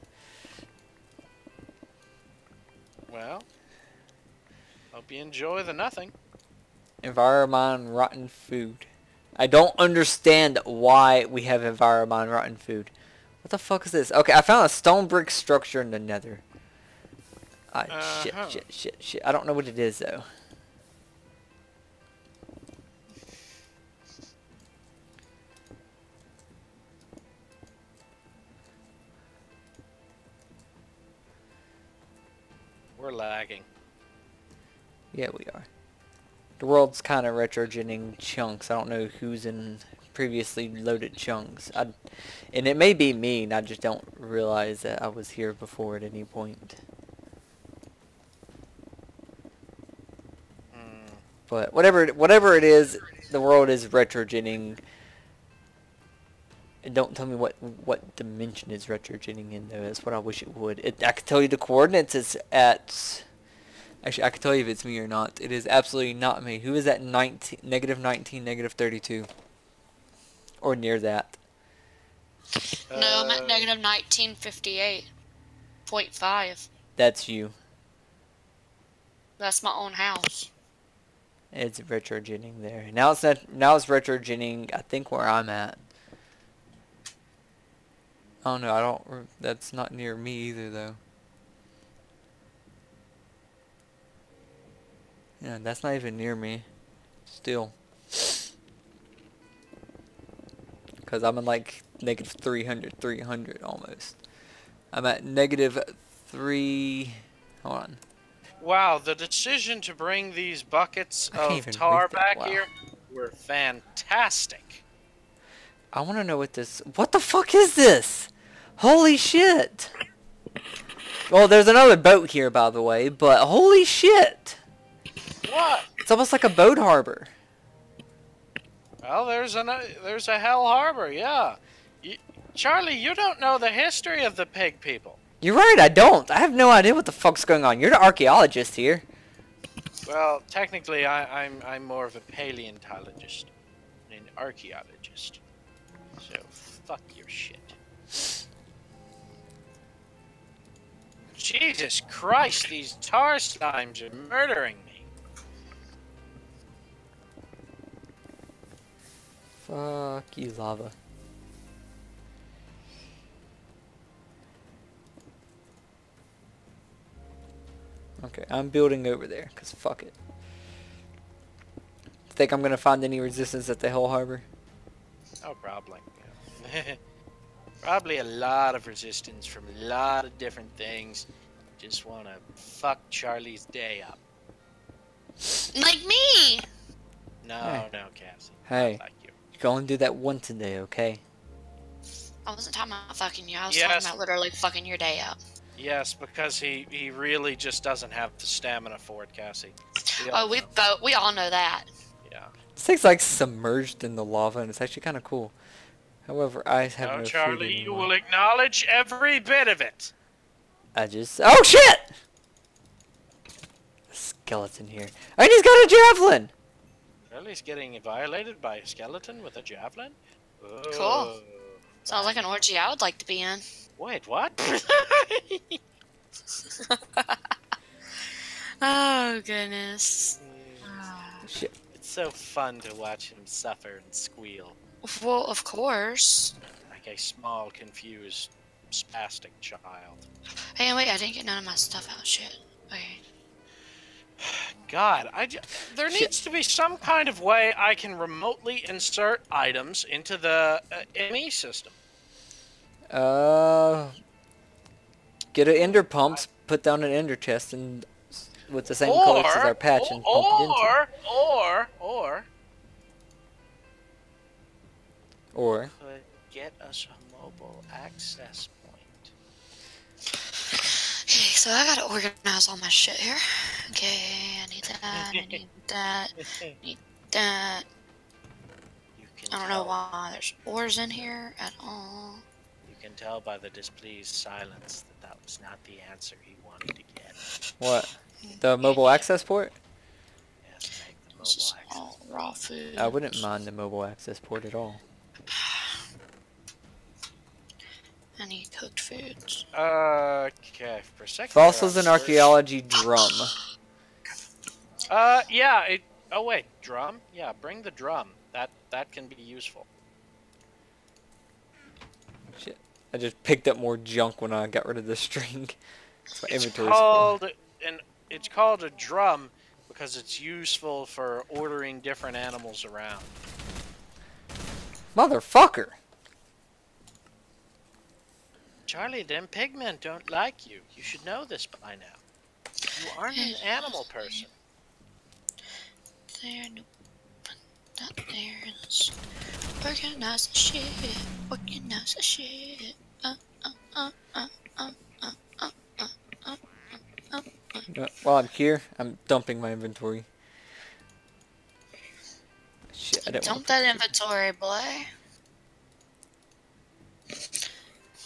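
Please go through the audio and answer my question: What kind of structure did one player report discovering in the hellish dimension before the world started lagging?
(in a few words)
stone brick structure.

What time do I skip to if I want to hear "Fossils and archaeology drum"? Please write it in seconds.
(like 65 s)
301 s.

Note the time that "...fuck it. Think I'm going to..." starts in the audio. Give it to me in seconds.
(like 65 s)
169 s.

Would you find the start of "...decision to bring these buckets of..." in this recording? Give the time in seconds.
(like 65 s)
109 s.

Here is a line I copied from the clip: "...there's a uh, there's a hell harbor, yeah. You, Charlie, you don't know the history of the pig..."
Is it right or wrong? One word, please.
right.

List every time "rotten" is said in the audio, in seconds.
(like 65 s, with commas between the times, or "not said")
7 s, 12 s.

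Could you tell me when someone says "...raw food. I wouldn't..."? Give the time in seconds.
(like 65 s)
292 s.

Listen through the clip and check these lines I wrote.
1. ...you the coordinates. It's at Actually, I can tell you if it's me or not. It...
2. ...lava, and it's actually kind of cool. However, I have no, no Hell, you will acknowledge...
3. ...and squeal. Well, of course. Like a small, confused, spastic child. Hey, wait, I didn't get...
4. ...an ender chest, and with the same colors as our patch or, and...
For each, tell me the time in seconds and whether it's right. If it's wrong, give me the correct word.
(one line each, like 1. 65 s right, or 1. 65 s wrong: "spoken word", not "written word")
1. 61 s right
2. 204 s wrong: "Charlie", not "Hell"
3. 234 s right
4. 257 s right.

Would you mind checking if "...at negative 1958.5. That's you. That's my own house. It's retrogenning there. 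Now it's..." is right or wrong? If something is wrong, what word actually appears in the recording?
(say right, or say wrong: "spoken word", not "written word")
right.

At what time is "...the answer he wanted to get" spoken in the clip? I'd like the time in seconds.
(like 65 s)
285 s.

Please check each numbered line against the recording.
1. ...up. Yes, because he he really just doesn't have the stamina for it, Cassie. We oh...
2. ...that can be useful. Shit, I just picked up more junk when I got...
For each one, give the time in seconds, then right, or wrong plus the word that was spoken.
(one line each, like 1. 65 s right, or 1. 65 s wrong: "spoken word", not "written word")
1. 195 s right
2. 308 s right.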